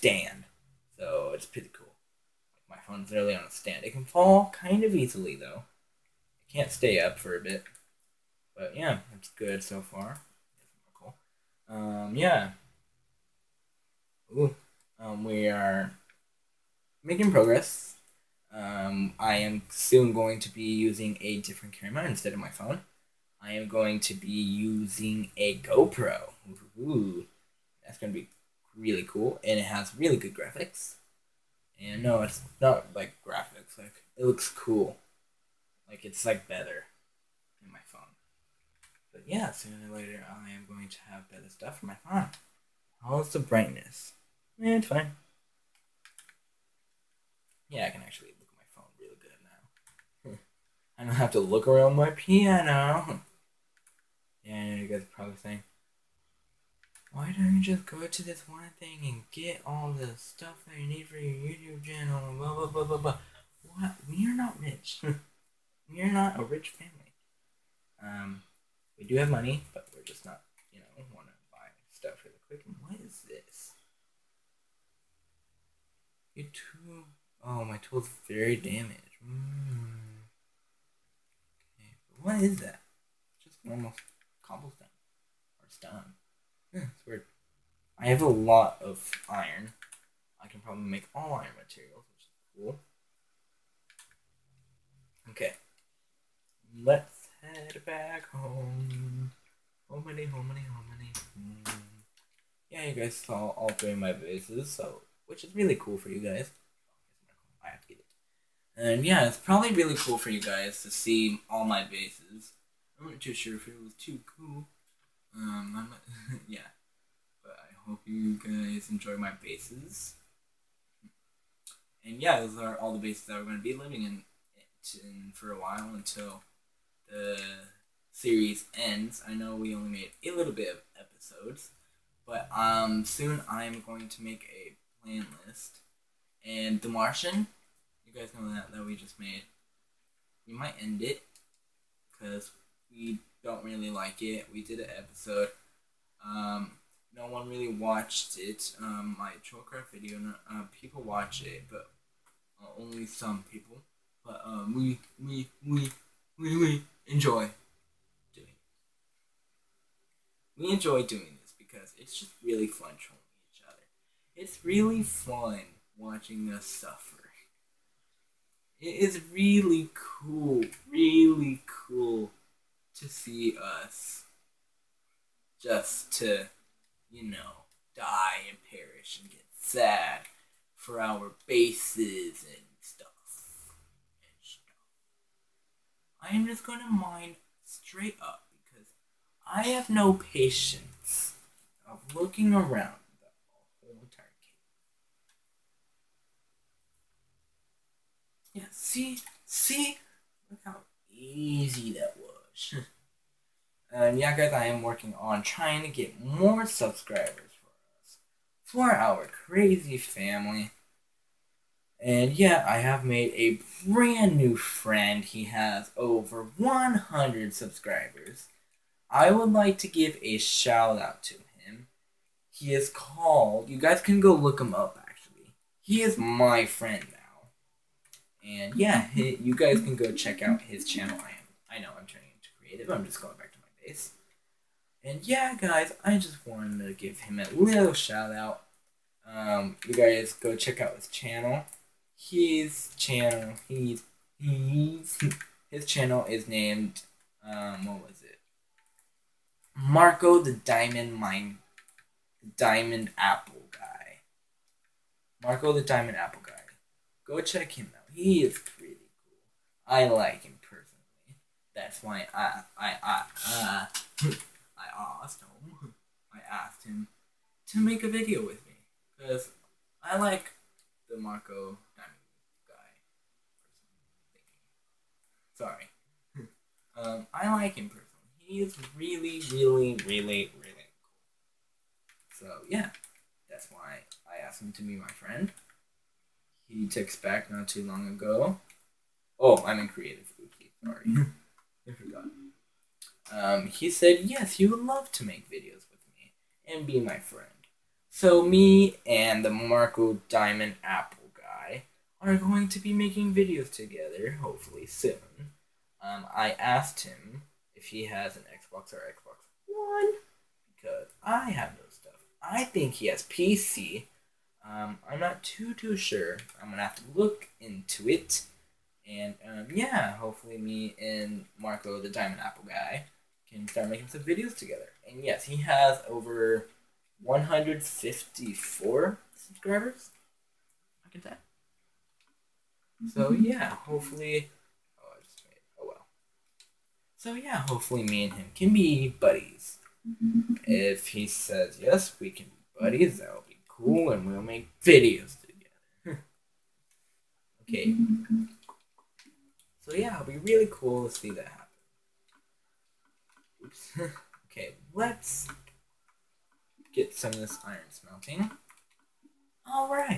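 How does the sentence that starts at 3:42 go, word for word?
He is called, you guys can go look him up actually.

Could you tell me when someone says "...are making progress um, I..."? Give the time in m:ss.
0:15.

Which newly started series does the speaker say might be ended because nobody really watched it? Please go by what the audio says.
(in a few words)
The Martian.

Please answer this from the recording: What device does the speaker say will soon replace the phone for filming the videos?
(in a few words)
GoPro.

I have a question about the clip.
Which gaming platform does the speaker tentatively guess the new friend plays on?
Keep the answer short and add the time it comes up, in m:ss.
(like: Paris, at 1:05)
PC, at 5:13.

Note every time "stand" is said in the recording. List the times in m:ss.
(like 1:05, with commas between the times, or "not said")
0:03.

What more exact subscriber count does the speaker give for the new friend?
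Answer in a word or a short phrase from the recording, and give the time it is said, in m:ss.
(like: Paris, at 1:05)
154, at 5:27.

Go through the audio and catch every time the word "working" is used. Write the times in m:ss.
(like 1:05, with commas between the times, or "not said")
3:24.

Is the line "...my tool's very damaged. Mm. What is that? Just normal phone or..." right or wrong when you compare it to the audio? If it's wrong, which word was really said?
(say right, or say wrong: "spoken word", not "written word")
wrong: "cobblestone", not "phone".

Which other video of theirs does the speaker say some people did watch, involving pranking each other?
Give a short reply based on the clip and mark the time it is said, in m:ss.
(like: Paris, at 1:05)
Trollcraft, at 2:29.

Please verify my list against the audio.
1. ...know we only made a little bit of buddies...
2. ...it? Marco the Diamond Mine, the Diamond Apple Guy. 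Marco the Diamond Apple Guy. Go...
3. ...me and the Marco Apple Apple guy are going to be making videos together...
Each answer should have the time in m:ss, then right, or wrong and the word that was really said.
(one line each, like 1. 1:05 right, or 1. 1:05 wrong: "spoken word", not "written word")
1. 2:09 wrong: "episodes", not "buddies"
2. 4:08 right
3. 4:58 wrong: "Diamond", not "Apple".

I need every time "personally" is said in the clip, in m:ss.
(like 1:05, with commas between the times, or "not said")
4:20, 4:37.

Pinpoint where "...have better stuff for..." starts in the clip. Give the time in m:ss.
0:41.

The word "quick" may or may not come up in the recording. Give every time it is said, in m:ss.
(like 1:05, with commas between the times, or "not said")
1:12.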